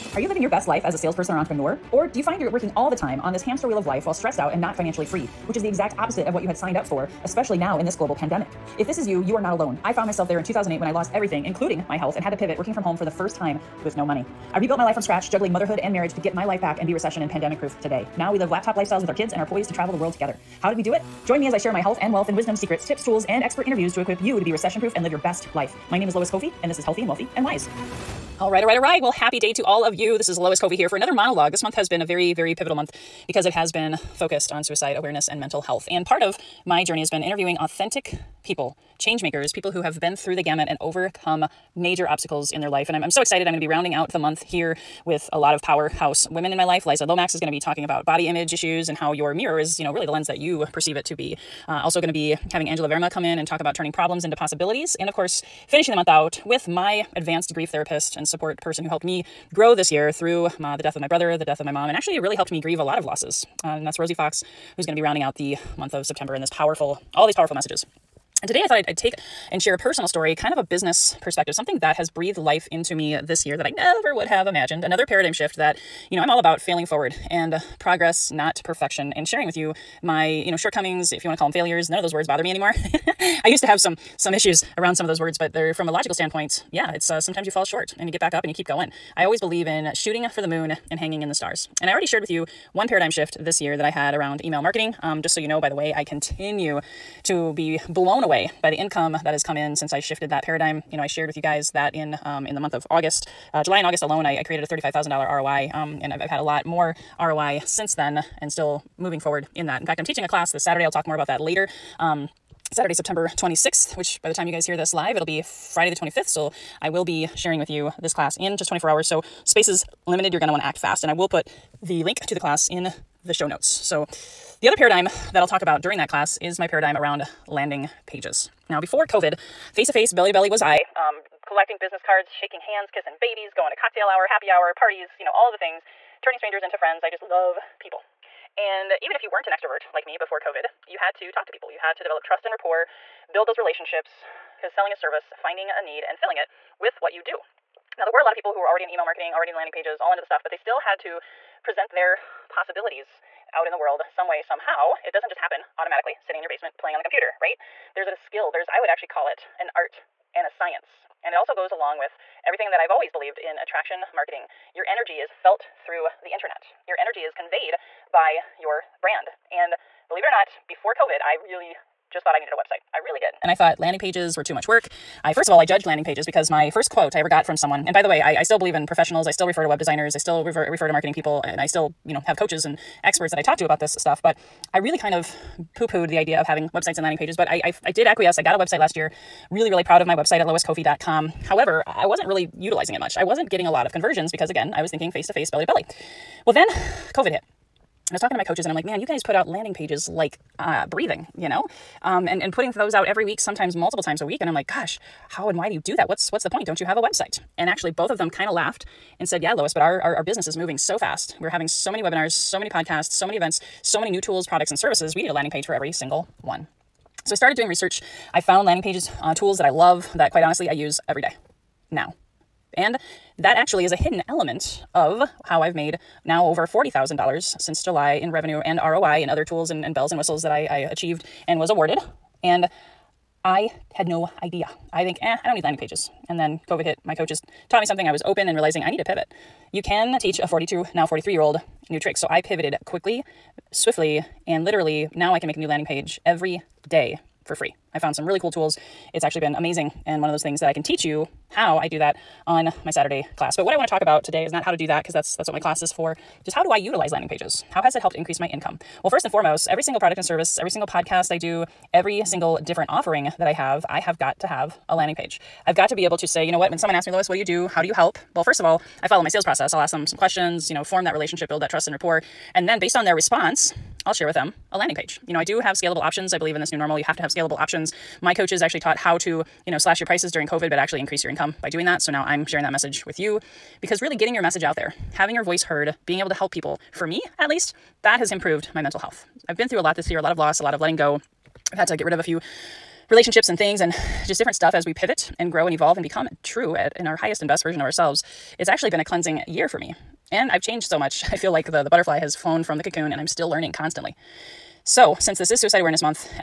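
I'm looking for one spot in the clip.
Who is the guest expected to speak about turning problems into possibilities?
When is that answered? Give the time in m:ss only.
0:52.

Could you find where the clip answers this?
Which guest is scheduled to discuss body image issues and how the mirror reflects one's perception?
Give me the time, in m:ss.
0:46.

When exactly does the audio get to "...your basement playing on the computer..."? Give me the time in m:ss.
2:36.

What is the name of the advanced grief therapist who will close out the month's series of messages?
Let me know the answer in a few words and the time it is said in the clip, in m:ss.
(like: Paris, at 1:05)
Rosie Fox, at 1:03.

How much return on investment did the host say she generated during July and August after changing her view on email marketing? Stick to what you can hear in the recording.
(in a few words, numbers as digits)
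$35,000.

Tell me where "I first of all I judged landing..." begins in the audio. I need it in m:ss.
2:55.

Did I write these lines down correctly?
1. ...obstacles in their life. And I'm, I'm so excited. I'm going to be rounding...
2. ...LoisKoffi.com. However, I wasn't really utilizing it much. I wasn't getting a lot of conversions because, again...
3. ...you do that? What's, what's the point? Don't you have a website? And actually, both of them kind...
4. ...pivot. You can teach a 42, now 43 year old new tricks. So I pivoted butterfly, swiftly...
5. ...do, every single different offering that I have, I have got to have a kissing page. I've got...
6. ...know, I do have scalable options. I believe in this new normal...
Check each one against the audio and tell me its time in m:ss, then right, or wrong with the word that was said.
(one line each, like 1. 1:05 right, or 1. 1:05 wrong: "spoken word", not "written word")
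1. 0:42 right
2. 3:10 right
3. 3:25 right
4. 3:59 wrong: "quickly", not "butterfly"
5. 4:21 wrong: "landing", not "kissing"
6. 4:35 right.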